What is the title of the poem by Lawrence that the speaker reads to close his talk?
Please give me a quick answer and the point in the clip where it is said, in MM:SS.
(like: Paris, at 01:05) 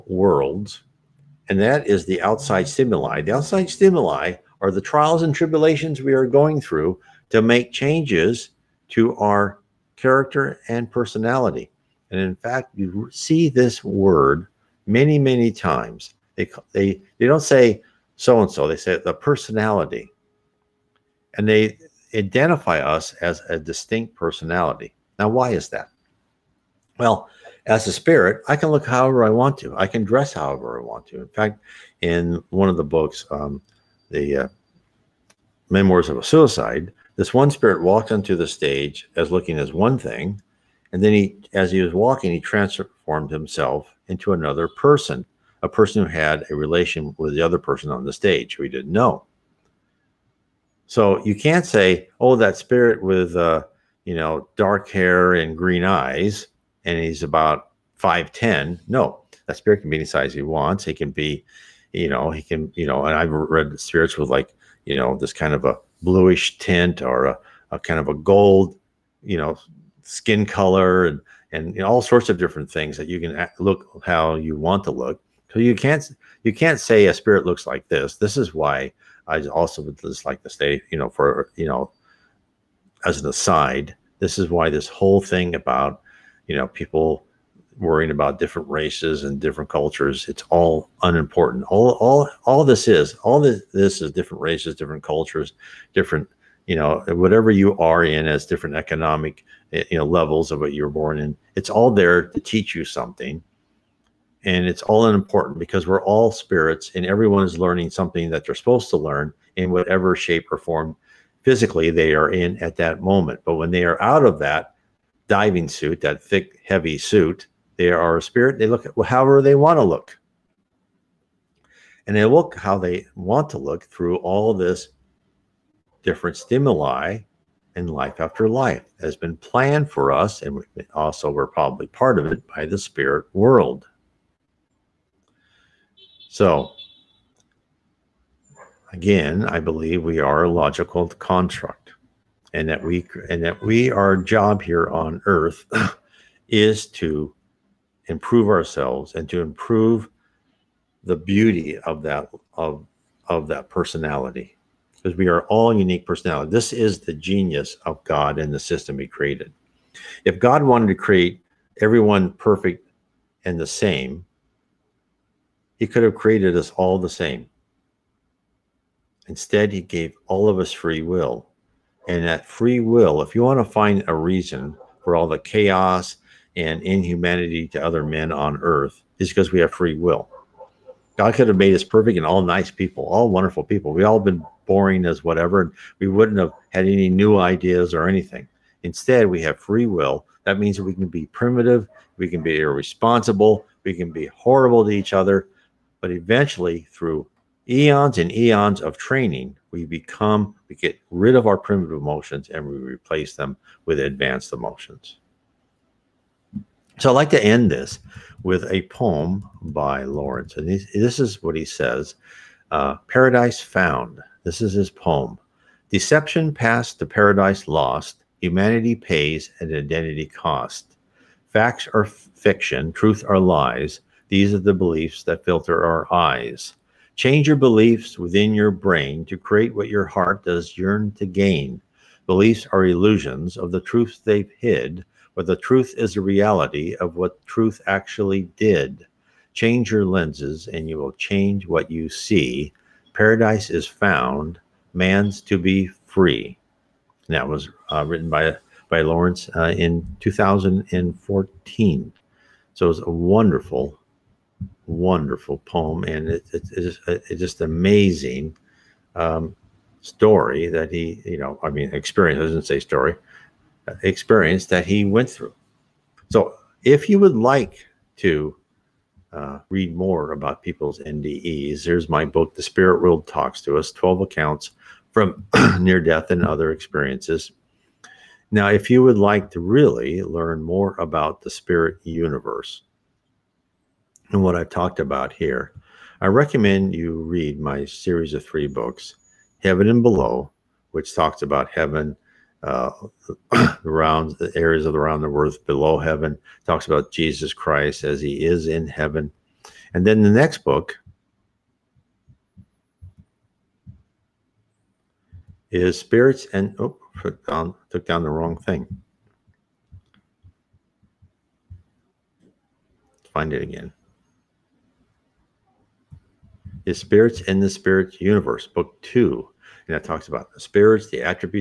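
Paradise Found, at 03:33.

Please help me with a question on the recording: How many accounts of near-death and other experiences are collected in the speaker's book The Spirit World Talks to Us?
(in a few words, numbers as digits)
12.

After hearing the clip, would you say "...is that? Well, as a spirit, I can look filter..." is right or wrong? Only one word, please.
wrong.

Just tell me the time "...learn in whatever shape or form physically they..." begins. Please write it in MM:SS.
01:48.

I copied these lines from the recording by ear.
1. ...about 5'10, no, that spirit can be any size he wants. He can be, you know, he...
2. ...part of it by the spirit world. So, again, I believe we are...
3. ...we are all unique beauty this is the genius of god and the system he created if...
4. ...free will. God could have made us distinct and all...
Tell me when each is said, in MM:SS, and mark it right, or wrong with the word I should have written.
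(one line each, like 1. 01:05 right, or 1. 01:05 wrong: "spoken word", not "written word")
1. 00:57 right
2. 02:11 right
3. 02:35 wrong: "personality", not "beauty"
4. 02:59 wrong: "perfect", not "distinct".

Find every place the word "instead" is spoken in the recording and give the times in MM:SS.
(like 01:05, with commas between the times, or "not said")
02:49, 03:08.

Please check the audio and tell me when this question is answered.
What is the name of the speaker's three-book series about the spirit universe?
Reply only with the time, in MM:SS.
04:49.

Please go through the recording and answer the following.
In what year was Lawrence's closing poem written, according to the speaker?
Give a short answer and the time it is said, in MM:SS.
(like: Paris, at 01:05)
2014, at 04:10.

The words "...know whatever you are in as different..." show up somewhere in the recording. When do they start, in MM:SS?
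01:36.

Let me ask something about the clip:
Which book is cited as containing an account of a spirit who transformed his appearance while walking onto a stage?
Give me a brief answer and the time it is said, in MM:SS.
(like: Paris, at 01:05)
Memoirs of a Suicide, at 00:35.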